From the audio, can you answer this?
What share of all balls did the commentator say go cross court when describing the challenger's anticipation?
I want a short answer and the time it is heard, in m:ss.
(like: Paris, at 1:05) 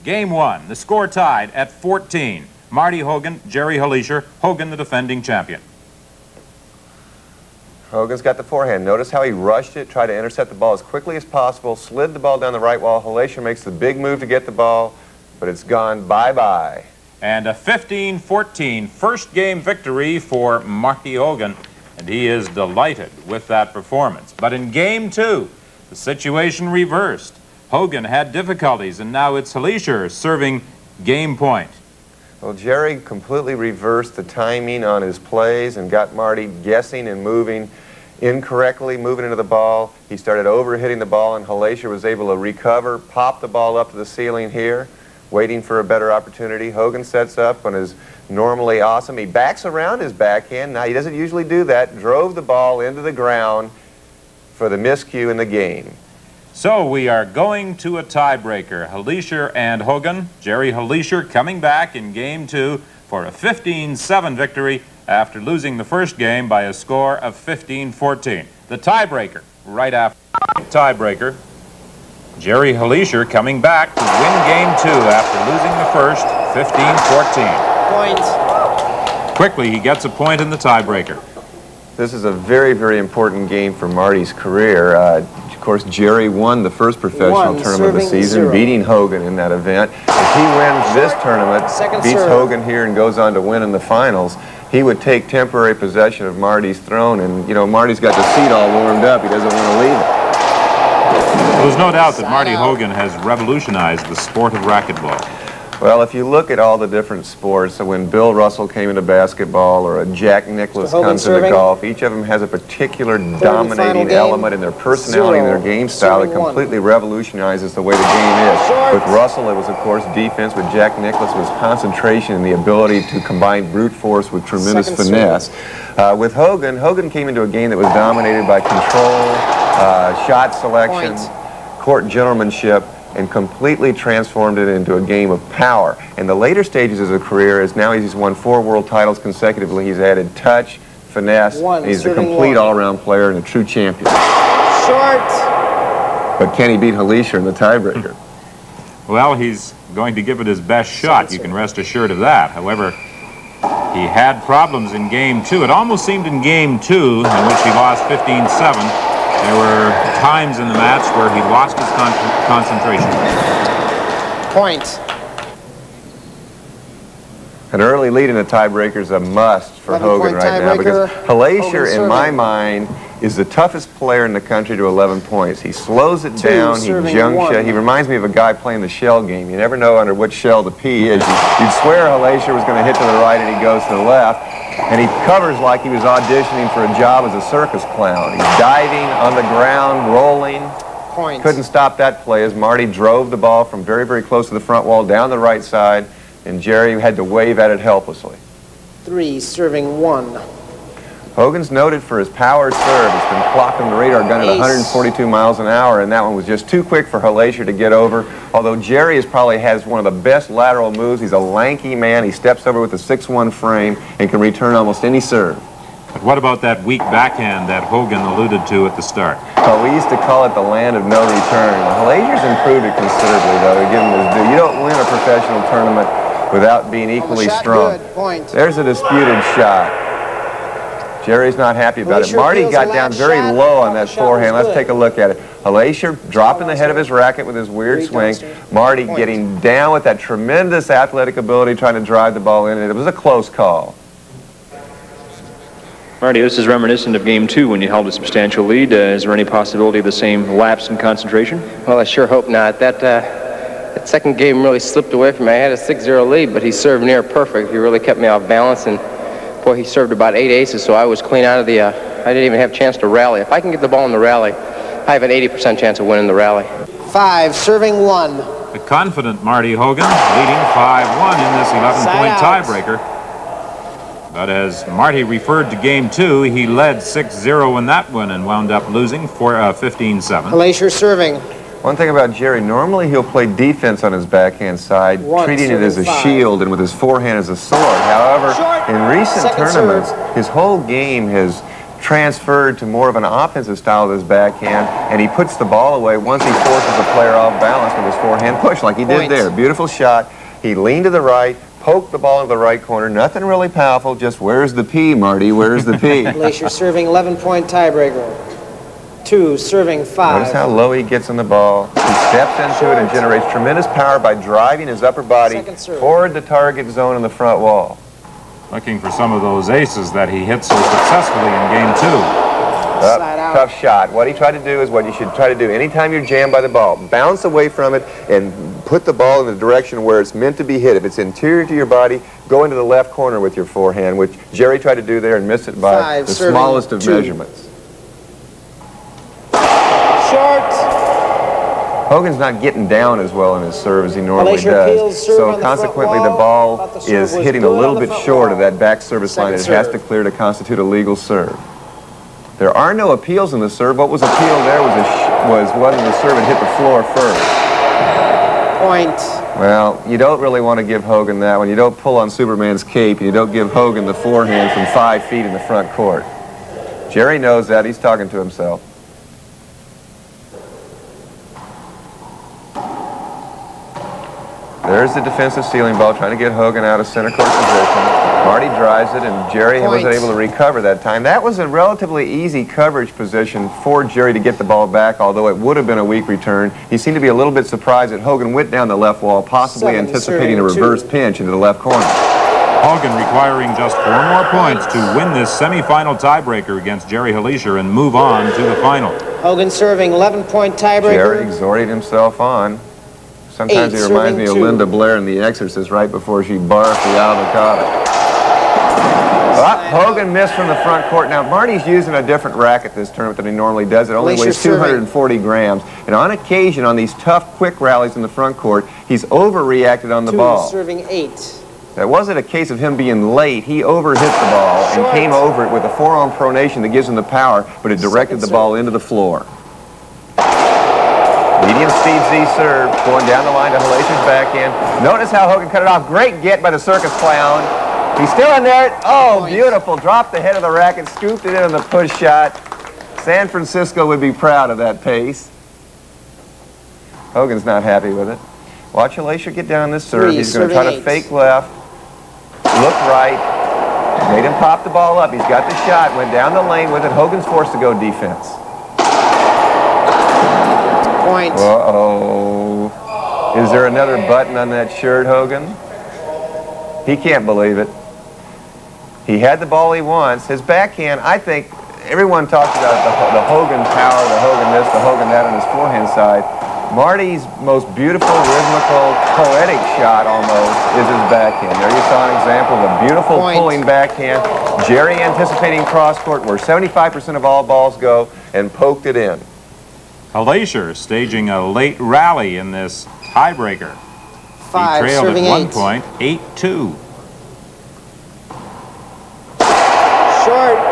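75%, at 8:06.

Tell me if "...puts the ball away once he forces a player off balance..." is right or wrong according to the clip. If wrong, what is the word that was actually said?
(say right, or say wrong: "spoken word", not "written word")
right.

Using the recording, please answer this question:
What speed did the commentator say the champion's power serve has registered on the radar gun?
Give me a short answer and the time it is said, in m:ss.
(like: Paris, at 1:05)
142 miles an hour, at 3:24.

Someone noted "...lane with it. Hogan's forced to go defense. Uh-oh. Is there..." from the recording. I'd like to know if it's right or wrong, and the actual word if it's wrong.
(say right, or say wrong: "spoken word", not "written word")
right.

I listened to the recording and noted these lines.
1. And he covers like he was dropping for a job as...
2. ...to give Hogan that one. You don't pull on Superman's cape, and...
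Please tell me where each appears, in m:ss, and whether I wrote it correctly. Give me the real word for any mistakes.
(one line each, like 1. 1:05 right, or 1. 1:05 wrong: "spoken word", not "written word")
1. 3:04 wrong: "auditioning", not "dropping"
2. 6:00 right.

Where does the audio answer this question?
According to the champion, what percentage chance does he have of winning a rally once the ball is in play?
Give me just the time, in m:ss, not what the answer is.
4:25.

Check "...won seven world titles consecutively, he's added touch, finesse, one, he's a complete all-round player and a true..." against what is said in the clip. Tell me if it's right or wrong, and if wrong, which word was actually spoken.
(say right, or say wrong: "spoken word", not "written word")
wrong: "four", not "seven".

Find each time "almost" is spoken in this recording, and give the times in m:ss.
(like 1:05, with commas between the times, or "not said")
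2:35, 3:34, 8:00.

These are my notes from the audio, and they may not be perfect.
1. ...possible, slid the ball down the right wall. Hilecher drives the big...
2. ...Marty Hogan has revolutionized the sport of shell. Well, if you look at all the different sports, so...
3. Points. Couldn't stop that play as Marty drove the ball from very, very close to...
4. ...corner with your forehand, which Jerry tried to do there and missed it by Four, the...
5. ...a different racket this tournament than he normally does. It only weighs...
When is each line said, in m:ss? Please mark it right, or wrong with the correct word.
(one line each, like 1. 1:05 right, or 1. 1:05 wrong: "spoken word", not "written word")
1. 0:11 wrong: "makes", not "drives"
2. 1:42 wrong: "racquetball", not "shell"
3. 3:11 right
4. 5:33 wrong: "Five", not "Four"
5. 6:52 right.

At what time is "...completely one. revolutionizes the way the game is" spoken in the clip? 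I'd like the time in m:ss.
1:56.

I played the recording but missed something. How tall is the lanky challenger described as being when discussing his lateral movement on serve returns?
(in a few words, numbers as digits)
6-1.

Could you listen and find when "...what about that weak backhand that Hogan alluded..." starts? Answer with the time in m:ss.
3:36.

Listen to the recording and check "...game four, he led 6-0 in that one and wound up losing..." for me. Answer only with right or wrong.
wrong.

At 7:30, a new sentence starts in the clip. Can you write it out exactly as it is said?
Three, He's going to try to fake left, look right.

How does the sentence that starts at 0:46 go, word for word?
Hogan sets up on his normally awesome.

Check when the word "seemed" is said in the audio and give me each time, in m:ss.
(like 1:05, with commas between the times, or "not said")
2:36, 6:26.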